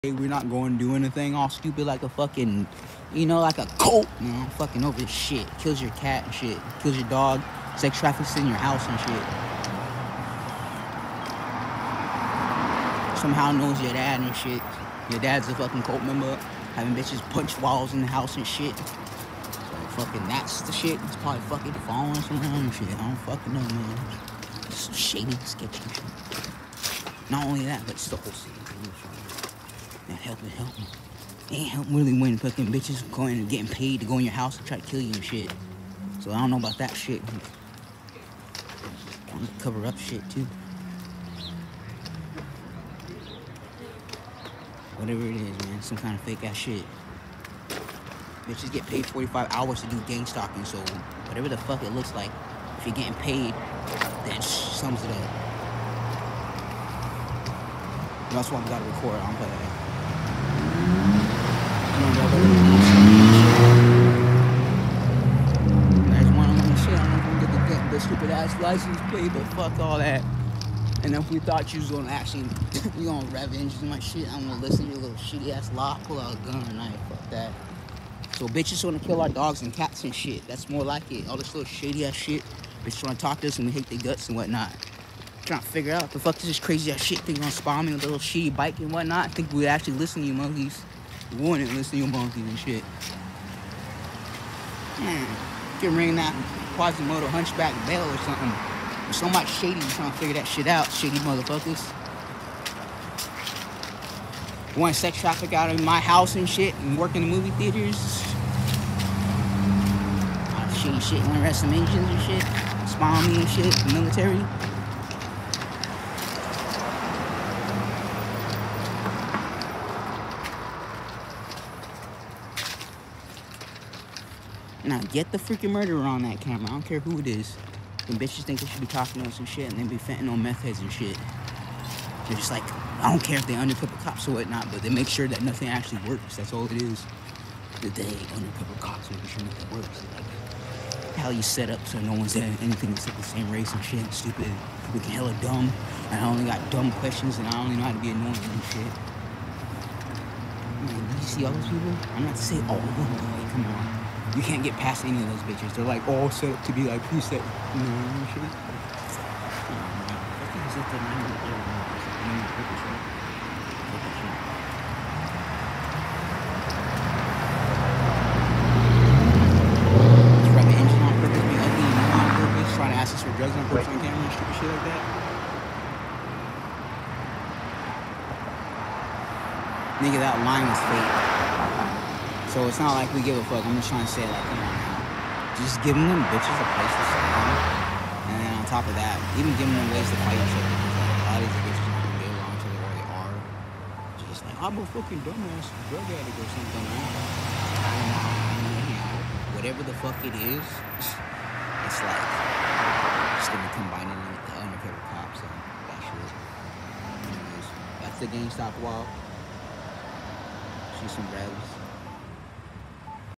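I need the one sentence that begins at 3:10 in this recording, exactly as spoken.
Because, like, a lot of these bitches not going get along to where they are.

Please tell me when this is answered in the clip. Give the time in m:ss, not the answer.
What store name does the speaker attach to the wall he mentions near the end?
3:28.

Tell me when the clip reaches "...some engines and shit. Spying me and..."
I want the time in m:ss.
1:51.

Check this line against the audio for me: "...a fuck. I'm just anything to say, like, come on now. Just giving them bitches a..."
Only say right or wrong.
wrong.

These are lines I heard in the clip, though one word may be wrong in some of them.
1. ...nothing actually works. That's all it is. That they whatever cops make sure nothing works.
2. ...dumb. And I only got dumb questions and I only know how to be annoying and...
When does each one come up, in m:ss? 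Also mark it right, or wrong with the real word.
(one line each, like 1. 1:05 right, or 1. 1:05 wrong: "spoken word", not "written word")
1. 2:15 wrong: "undercover", not "whatever"
2. 2:25 right.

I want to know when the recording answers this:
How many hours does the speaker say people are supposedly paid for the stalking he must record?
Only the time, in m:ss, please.
0:49.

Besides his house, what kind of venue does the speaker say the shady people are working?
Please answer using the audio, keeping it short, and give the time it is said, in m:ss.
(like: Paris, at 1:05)
movie theaters, at 1:47.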